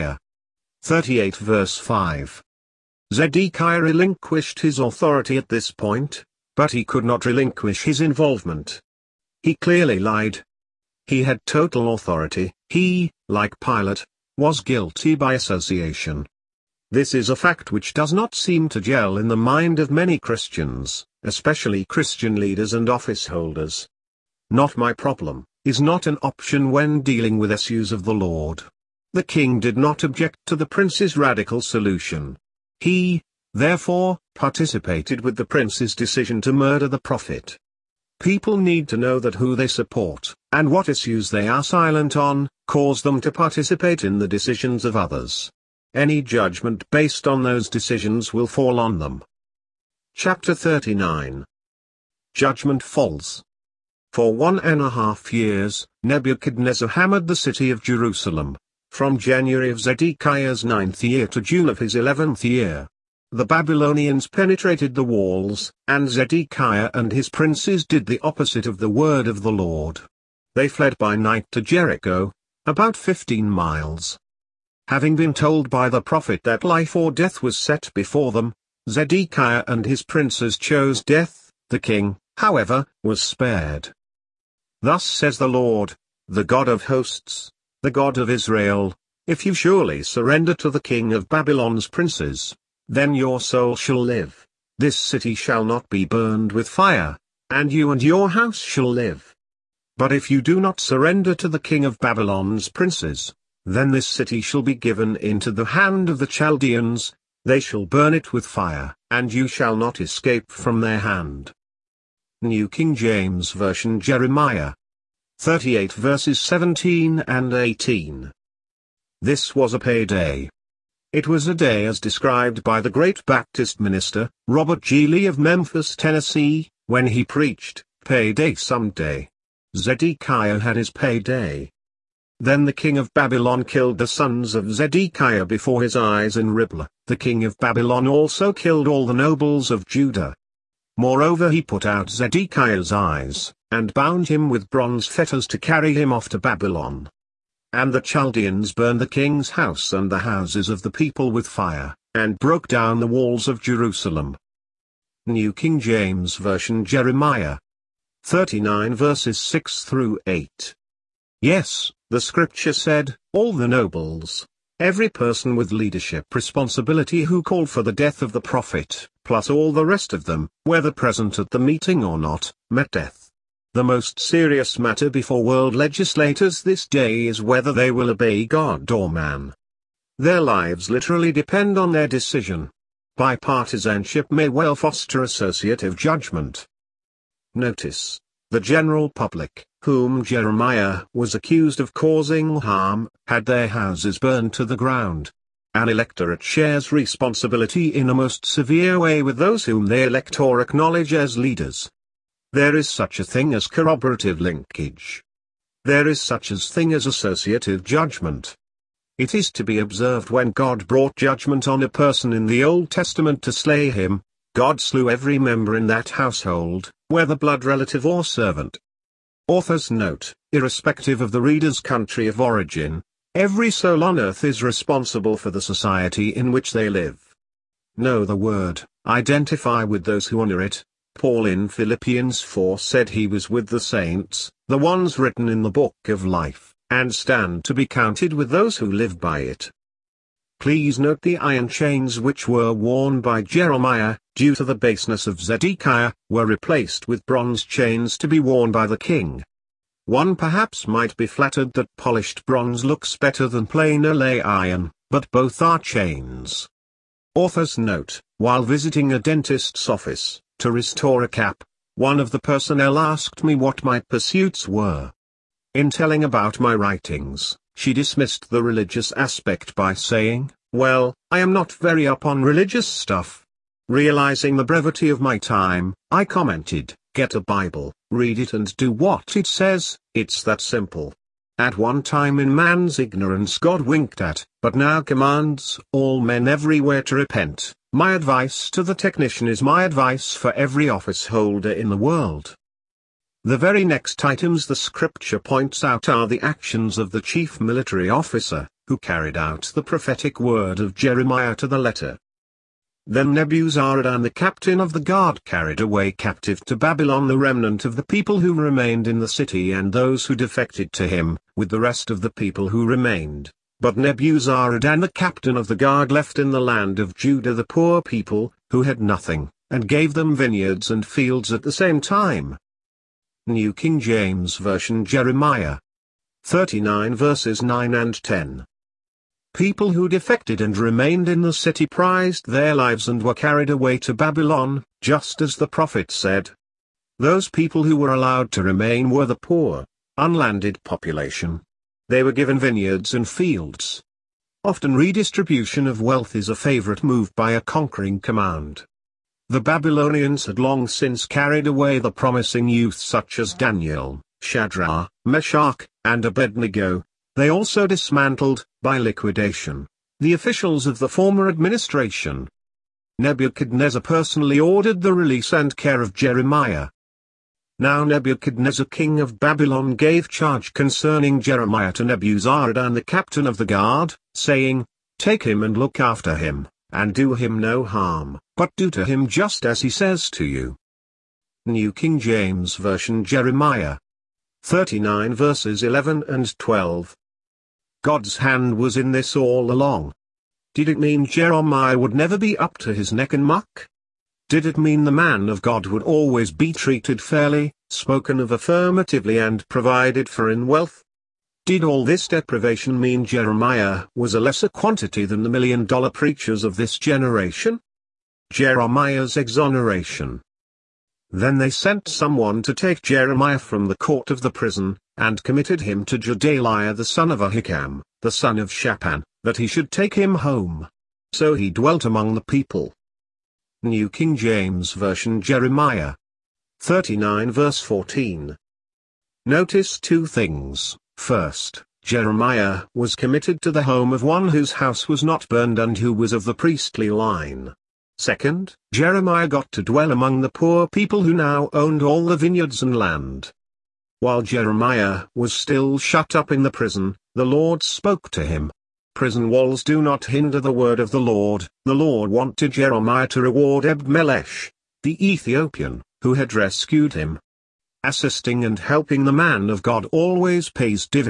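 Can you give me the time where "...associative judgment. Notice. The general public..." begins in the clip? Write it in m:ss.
3:05.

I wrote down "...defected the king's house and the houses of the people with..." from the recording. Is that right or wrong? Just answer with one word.
wrong.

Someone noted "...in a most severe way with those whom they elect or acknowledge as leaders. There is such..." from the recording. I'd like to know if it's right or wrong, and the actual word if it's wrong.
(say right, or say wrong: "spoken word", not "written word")
right.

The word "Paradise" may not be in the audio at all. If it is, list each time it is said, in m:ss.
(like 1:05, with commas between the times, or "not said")
not said.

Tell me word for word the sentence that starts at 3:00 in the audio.
Their lives literally depend on their decision.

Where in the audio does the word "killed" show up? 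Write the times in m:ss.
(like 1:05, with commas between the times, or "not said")
2:13, 2:18.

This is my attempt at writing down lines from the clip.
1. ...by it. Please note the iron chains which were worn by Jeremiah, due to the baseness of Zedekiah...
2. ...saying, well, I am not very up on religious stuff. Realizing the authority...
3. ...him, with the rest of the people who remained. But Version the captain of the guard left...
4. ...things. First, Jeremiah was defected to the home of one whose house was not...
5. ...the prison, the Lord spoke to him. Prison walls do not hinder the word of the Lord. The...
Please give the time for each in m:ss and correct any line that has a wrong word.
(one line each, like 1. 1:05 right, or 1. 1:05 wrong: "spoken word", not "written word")
1. 3:59 right
2. 4:29 wrong: "brevity", not "authority"
3. 5:11 wrong: "Nebuzaradan", not "Version"
4. 7:10 wrong: "committed", not "defected"
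5. 7:26 right.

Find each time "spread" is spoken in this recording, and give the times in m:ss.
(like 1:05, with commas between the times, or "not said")
not said.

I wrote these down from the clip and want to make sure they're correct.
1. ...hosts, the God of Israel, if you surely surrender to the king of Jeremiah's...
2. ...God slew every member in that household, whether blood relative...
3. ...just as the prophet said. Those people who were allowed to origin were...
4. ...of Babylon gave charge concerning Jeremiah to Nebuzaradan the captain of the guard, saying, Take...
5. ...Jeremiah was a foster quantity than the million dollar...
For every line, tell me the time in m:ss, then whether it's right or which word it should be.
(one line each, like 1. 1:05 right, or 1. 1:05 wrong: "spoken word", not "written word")
1. 1:26 wrong: "Babylon", not "Jeremiah"
2. 3:34 right
3. 5:35 wrong: "remain", not "origin"
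4. 6:09 right
5. 6:43 wrong: "lesser", not "foster".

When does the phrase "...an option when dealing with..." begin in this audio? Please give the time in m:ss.
0:26.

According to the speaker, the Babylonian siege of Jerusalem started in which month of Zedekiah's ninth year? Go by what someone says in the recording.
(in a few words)
January.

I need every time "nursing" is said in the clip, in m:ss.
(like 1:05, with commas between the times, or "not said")
not said.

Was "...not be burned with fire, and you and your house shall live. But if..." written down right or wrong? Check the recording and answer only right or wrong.
right.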